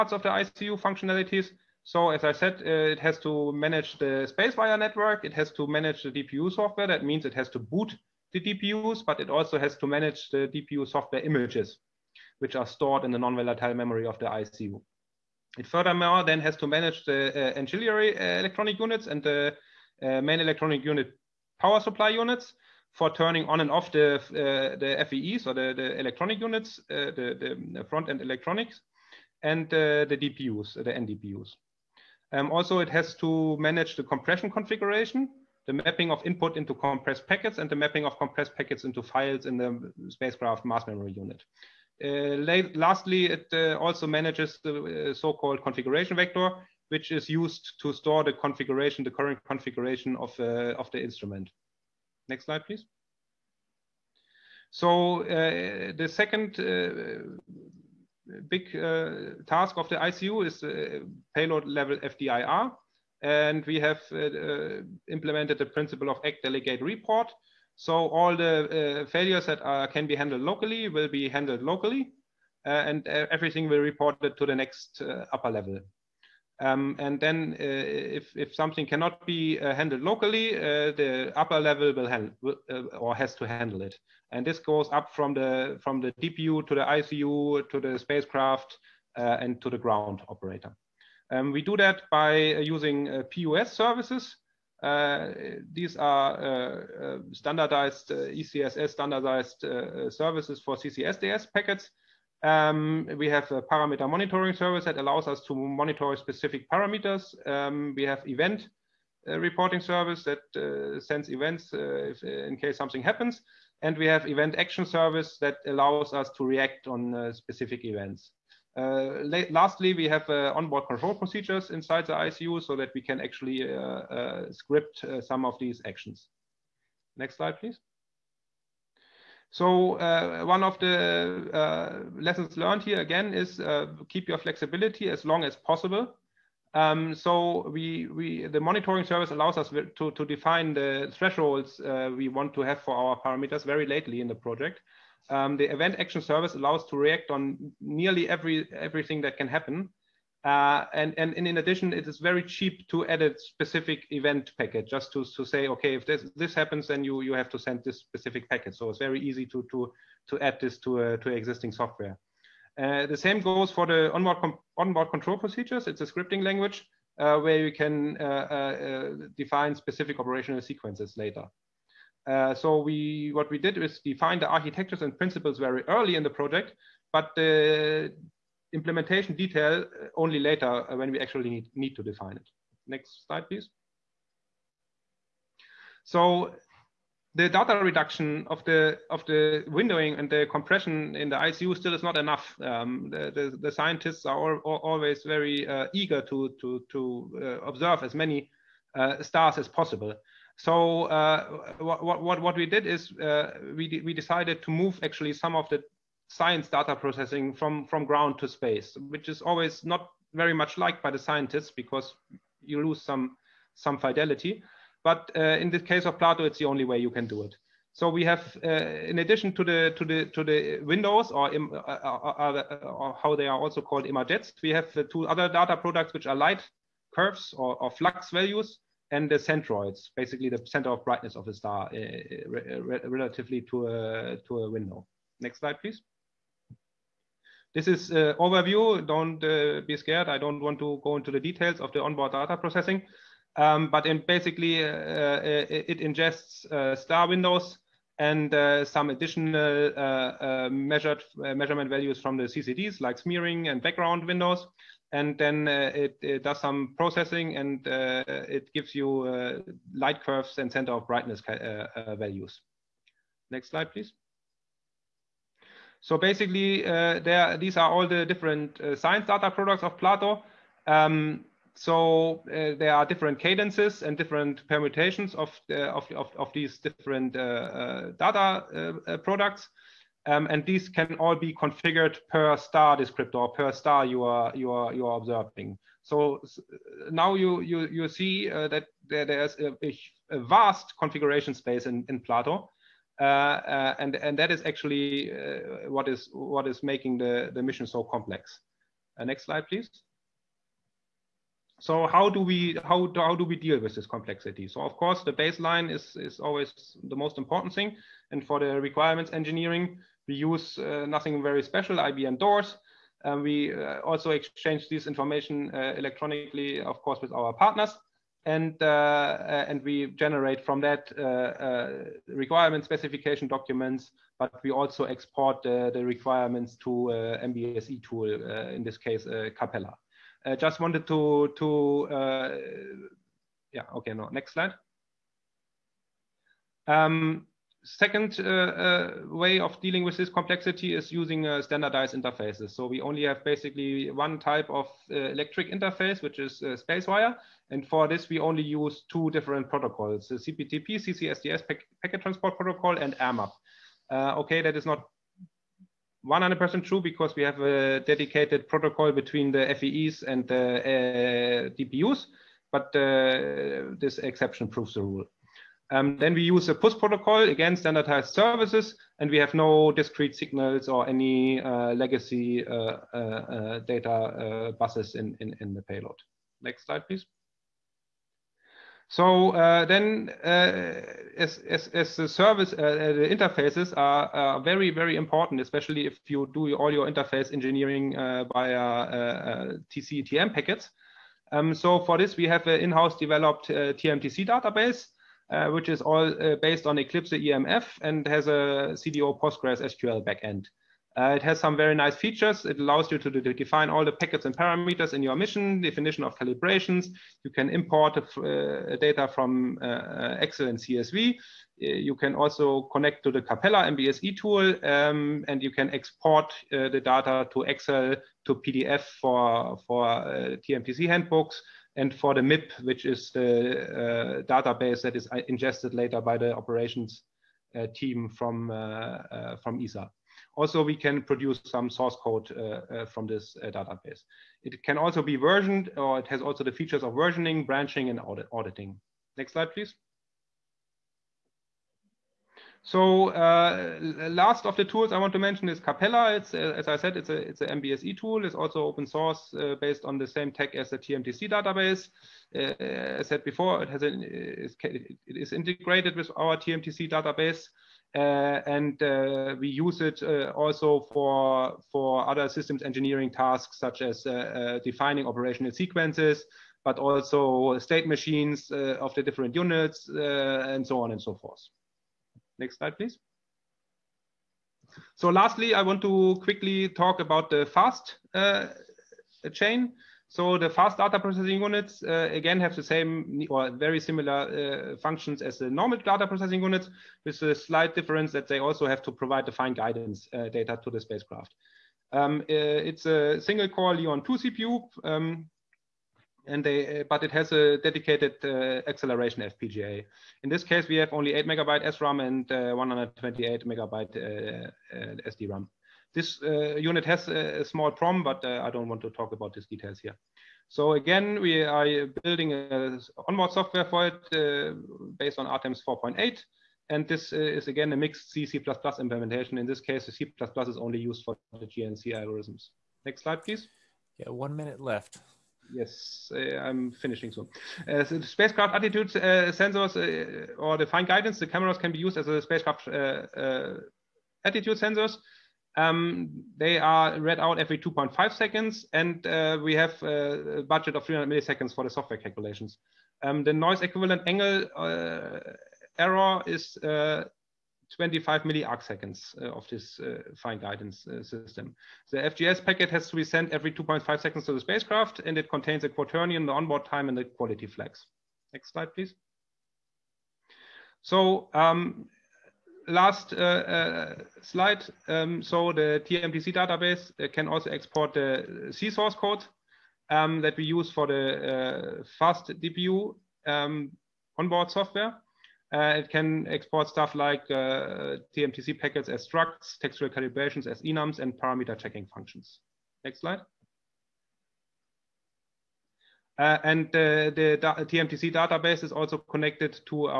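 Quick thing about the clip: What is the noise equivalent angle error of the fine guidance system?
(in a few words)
25 milliarcseconds.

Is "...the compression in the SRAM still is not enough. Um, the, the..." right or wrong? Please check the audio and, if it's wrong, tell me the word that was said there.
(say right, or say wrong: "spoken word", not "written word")
wrong: "ICU", not "SRAM".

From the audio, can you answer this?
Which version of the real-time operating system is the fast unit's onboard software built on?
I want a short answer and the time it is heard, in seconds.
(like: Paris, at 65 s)
RTEMS 4.8, at 515 s.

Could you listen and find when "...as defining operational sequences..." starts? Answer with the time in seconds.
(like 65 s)
464 s.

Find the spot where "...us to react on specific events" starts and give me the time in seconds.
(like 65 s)
116 s.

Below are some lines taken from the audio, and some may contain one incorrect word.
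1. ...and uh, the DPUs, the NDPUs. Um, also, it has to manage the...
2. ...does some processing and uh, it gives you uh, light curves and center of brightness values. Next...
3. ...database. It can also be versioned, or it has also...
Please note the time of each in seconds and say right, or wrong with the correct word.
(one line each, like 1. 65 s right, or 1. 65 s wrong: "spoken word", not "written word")
1. 29 s right
2. 256 s right
3. 433 s right.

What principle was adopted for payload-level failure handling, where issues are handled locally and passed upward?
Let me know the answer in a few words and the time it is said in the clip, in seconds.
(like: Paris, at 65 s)
act delegate report, at 66 s.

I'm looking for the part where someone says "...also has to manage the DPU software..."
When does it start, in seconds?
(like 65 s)
9 s.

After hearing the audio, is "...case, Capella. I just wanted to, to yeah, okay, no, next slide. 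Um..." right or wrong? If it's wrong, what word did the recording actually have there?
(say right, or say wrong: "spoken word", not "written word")
right.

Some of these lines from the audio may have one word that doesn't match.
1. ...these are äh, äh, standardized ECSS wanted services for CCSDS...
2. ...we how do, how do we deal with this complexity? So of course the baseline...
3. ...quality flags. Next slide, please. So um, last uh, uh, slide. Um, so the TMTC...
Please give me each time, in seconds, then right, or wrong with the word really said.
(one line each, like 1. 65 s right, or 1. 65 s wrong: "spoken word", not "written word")
1. 95 s wrong: "standardized", not "wanted"
2. 302 s right
3. 557 s right.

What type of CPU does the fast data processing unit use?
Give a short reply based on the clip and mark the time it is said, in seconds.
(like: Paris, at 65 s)
single core Leon 2, at 493 s.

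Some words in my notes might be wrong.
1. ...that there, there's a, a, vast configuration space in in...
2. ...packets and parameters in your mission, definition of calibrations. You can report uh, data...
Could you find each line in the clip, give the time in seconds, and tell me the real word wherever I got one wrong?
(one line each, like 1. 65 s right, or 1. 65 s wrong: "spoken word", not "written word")
1. 288 s right
2. 404 s wrong: "import", not "report".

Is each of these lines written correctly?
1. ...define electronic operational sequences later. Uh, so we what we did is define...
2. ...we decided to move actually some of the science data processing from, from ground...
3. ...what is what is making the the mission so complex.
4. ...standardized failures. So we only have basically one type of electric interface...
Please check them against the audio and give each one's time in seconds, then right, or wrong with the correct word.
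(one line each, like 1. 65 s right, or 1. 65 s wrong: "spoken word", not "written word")
1. 169 s wrong: "specific", not "electronic"
2. 204 s right
3. 295 s right
4. 341 s wrong: "interfaces", not "failures".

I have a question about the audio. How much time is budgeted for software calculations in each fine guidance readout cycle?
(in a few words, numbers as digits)
300 milliseconds.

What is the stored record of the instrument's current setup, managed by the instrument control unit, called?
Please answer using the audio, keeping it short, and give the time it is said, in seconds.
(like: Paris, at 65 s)
configuration vector, at 45 s.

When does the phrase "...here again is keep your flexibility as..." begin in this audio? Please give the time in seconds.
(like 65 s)
132 s.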